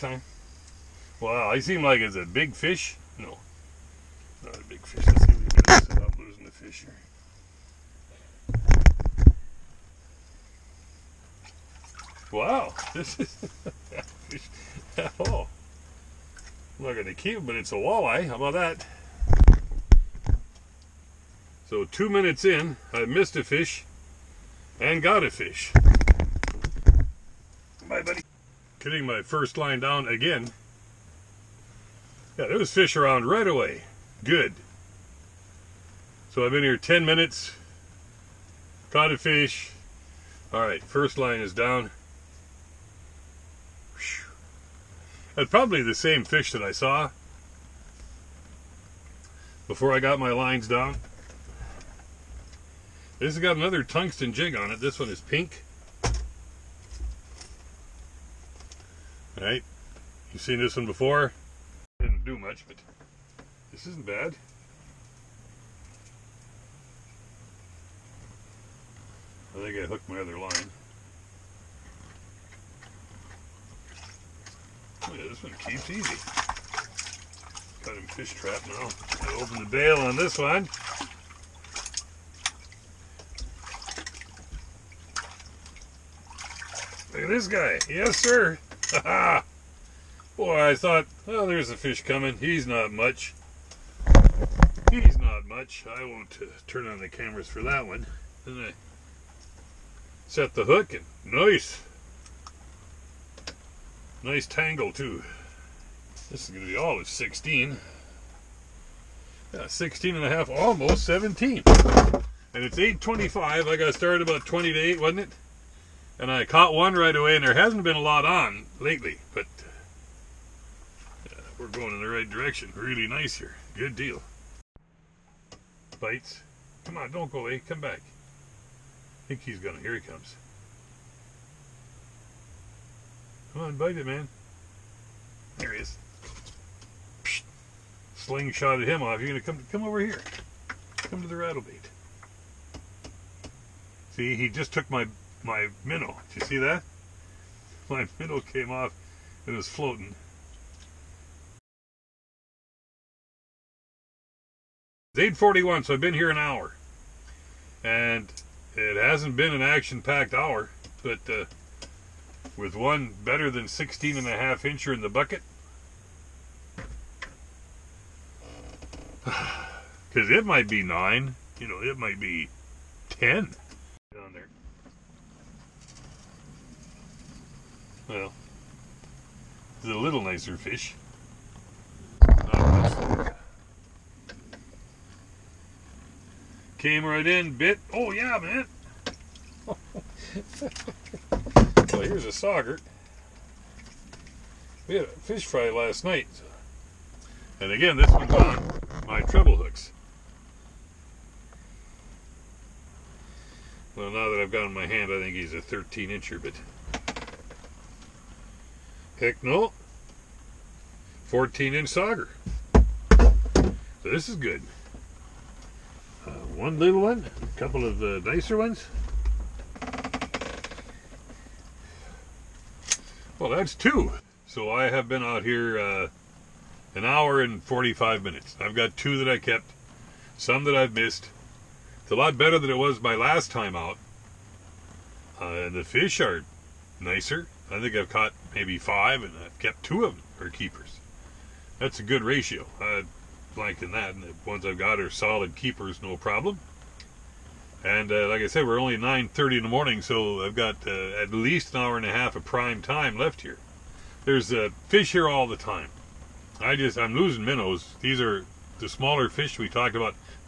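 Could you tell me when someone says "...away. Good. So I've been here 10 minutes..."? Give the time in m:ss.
0:33.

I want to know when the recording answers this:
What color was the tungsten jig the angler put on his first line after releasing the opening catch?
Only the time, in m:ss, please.
0:55.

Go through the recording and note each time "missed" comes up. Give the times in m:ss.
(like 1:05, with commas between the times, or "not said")
0:23, 3:50.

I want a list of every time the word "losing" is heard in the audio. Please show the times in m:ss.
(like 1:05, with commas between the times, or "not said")
0:06, 4:17.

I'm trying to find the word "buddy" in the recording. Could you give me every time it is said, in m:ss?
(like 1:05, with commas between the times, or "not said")
0:28.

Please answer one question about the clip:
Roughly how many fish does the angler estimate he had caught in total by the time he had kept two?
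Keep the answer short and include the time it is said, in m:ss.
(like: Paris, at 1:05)
5, at 3:58.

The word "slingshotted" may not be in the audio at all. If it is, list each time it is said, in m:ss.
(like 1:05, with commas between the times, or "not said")
2:18.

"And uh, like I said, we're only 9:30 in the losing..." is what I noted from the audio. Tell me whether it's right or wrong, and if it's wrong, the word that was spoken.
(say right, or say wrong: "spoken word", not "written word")
wrong: "morning", not "losing".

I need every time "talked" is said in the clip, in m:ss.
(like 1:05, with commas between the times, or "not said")
4:19.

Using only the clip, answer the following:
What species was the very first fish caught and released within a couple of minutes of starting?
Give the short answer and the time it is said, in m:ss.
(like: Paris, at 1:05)
Walleye, at 0:17.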